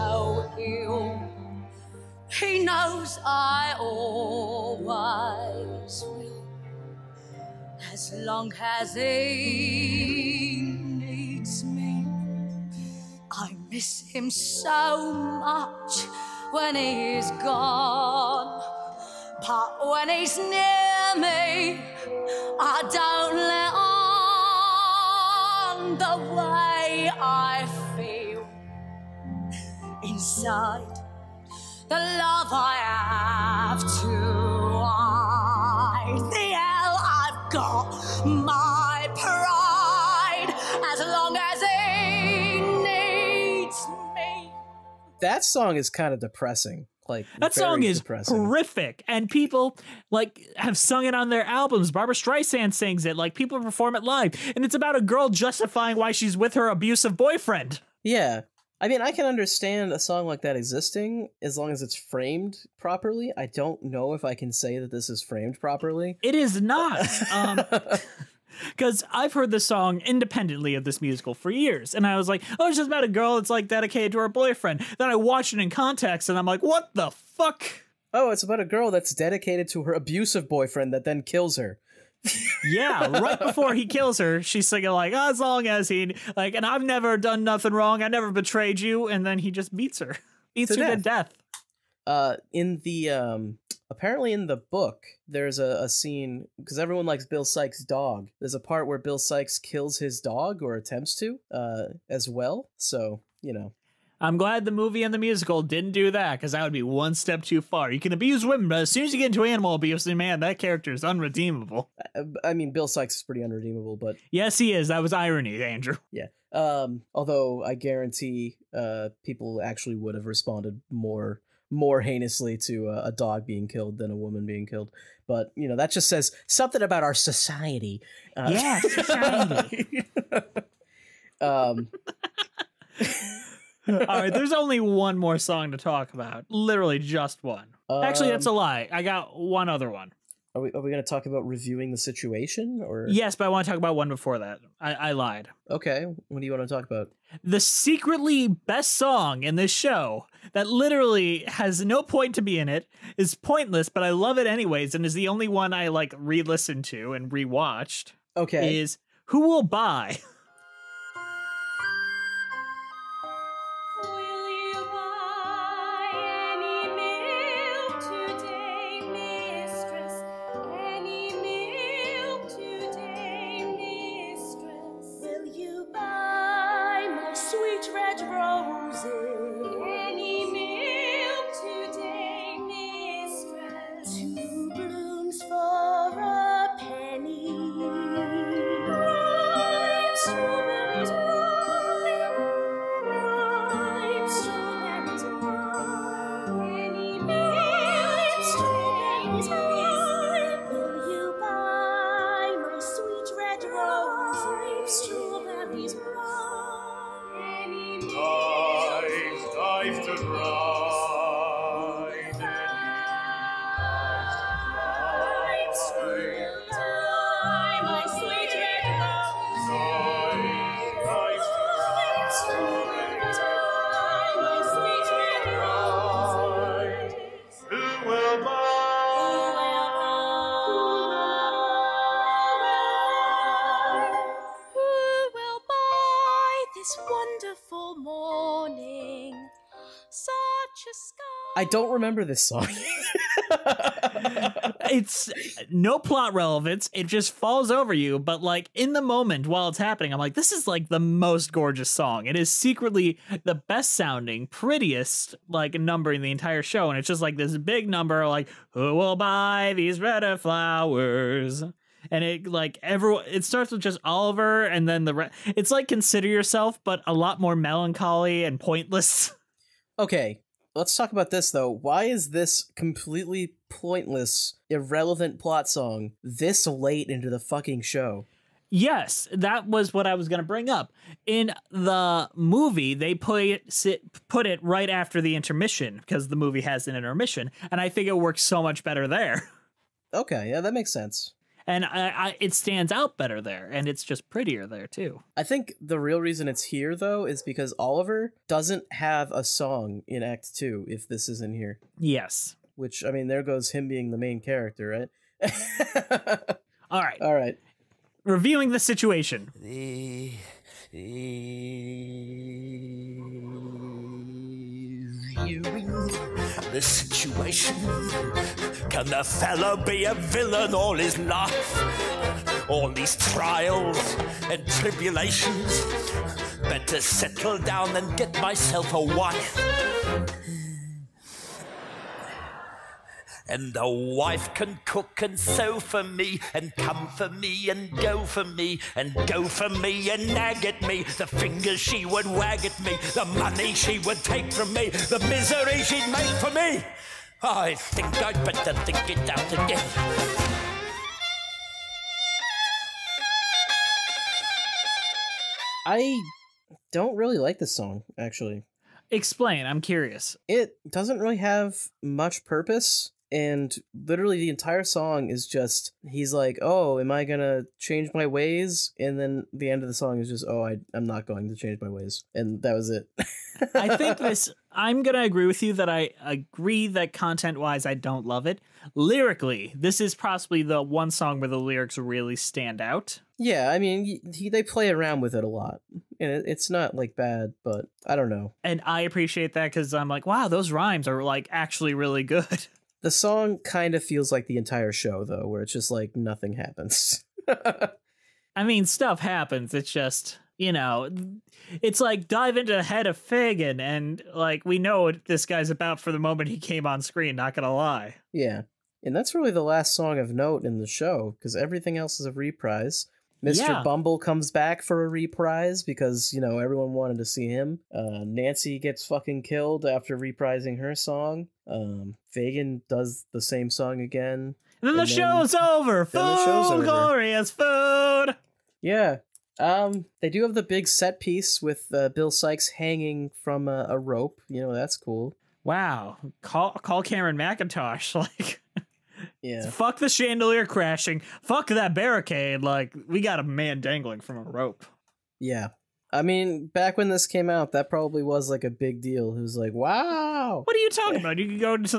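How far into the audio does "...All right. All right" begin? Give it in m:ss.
5:06.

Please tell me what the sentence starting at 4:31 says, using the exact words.
Why is this completely pointless, irrelevant plot song this late into the fucking show?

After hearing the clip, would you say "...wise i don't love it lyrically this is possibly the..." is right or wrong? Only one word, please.
right.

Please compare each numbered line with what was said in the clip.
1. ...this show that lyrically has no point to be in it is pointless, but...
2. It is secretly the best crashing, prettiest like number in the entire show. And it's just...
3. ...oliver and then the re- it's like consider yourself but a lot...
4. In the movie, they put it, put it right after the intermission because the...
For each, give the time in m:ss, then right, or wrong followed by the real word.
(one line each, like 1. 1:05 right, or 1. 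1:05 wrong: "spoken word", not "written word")
1. 2:29 wrong: "literally", not "lyrically"
2. 4:12 wrong: "sounding", not "crashing"
3. 4:24 right
4. 4:41 right.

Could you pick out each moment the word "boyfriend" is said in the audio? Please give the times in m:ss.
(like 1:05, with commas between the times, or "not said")
0:57, 1:14, 1:20.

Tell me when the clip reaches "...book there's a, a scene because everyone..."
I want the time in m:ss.
1:34.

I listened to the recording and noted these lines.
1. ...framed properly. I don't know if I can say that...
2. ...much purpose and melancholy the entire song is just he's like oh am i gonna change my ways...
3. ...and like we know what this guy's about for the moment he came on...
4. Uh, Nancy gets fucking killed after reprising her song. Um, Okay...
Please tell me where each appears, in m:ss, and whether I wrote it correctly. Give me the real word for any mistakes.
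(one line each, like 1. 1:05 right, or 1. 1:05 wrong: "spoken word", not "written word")
1. 1:01 right
2. 6:02 wrong: "literally", not "melancholy"
3. 6:43 right
4. 6:57 wrong: "Fagin", not "Okay".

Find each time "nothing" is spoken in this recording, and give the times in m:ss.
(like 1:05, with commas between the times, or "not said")
1:27, 6:36.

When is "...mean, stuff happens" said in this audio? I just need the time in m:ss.
6:38.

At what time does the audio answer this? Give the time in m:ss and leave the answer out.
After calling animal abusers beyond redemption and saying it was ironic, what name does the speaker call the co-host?
1:55.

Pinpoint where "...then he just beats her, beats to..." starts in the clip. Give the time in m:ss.
1:29.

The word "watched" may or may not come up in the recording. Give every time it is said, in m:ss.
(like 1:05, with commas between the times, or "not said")
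1:15, 2:37.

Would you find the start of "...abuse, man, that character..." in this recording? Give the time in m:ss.
1:49.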